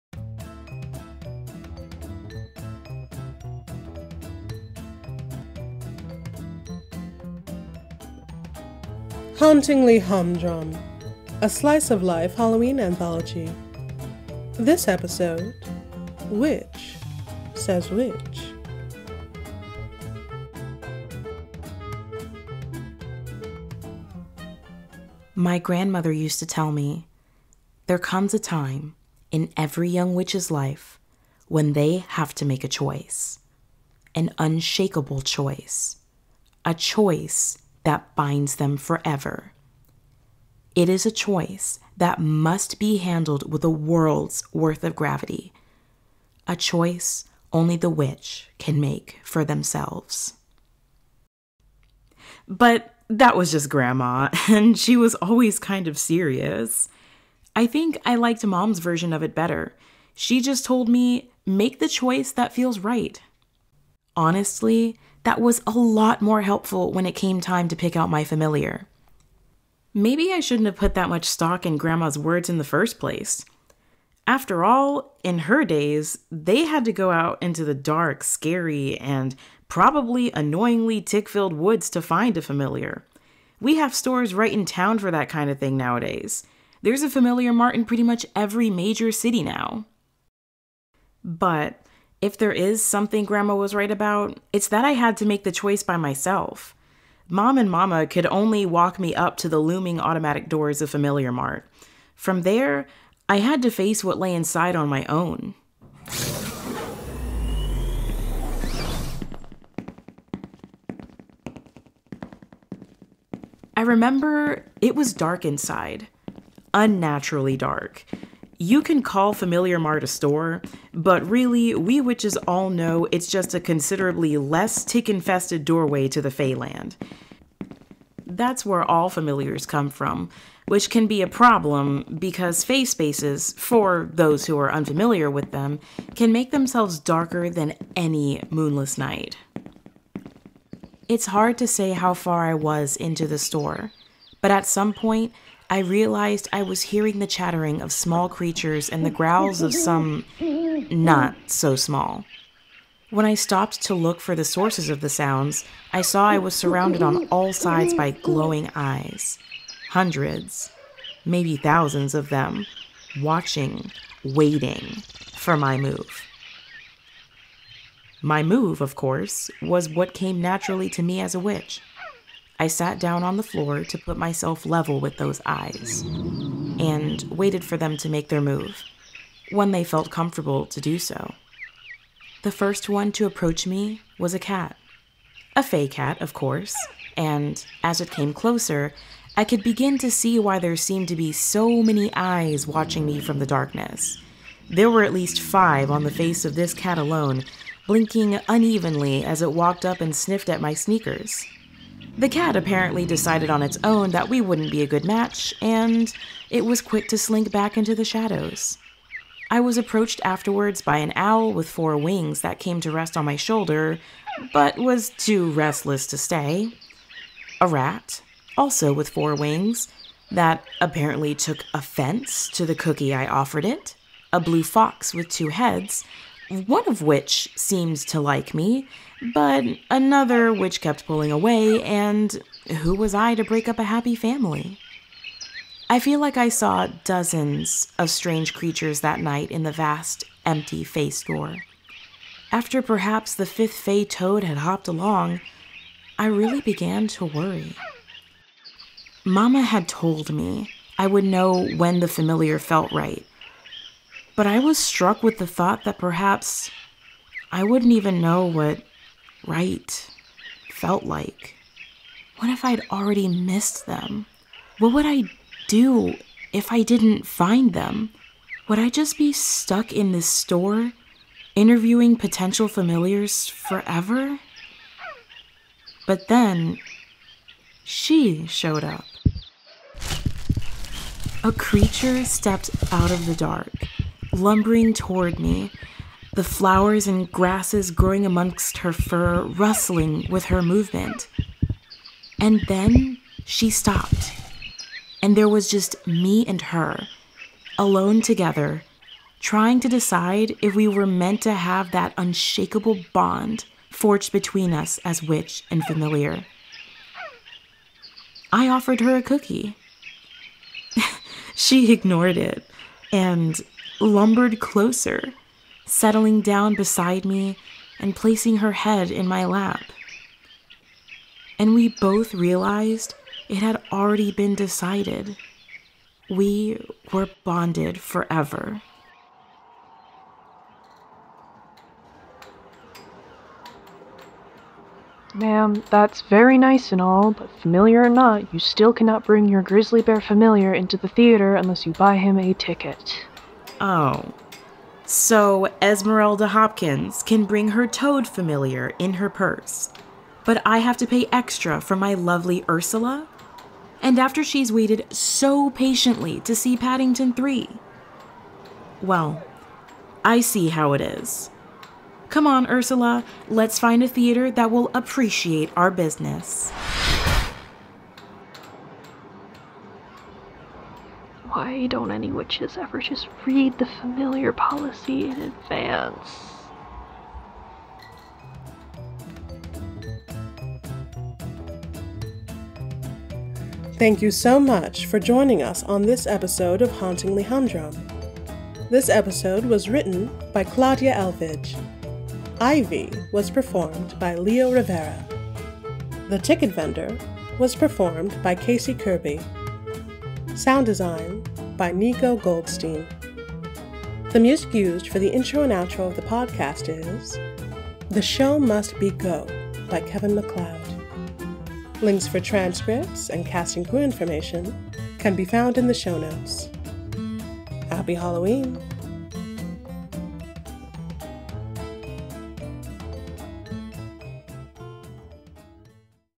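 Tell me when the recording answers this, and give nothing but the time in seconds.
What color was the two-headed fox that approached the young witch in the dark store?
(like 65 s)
224 s.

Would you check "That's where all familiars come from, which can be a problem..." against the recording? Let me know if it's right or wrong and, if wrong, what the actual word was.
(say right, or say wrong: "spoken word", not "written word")
right.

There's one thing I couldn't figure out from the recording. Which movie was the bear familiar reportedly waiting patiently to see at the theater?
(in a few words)
Paddington 3.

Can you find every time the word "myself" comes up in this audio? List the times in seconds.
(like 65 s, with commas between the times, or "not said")
95 s, 174 s.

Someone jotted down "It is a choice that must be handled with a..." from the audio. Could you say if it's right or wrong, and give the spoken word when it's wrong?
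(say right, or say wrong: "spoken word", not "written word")
right.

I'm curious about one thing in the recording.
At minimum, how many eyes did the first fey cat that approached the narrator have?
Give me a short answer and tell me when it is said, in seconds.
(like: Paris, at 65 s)
5, at 195 s.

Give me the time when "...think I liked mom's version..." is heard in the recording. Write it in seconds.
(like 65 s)
57 s.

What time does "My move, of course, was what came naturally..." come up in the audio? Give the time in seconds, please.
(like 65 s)
168 s.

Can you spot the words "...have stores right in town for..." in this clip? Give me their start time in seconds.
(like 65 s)
83 s.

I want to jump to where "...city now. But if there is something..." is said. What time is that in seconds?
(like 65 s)
89 s.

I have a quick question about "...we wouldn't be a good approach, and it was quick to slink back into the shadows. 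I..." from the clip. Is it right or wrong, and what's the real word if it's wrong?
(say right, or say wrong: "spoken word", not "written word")
wrong: "match", not "approach".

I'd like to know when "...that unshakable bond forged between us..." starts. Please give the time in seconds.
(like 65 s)
301 s.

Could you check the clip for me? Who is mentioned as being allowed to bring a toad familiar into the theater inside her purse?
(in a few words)
Esmeralda Hopkins.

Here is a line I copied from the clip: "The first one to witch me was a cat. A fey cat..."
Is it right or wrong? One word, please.
wrong.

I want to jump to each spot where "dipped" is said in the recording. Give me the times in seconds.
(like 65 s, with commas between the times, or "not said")
not said.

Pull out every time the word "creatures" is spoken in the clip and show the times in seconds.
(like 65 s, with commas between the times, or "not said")
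148 s, 238 s, 281 s.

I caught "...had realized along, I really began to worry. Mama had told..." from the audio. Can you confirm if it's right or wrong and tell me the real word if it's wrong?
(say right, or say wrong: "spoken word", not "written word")
wrong: "hopped", not "realized".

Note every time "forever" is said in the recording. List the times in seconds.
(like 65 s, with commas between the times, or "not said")
38 s, 273 s, 327 s.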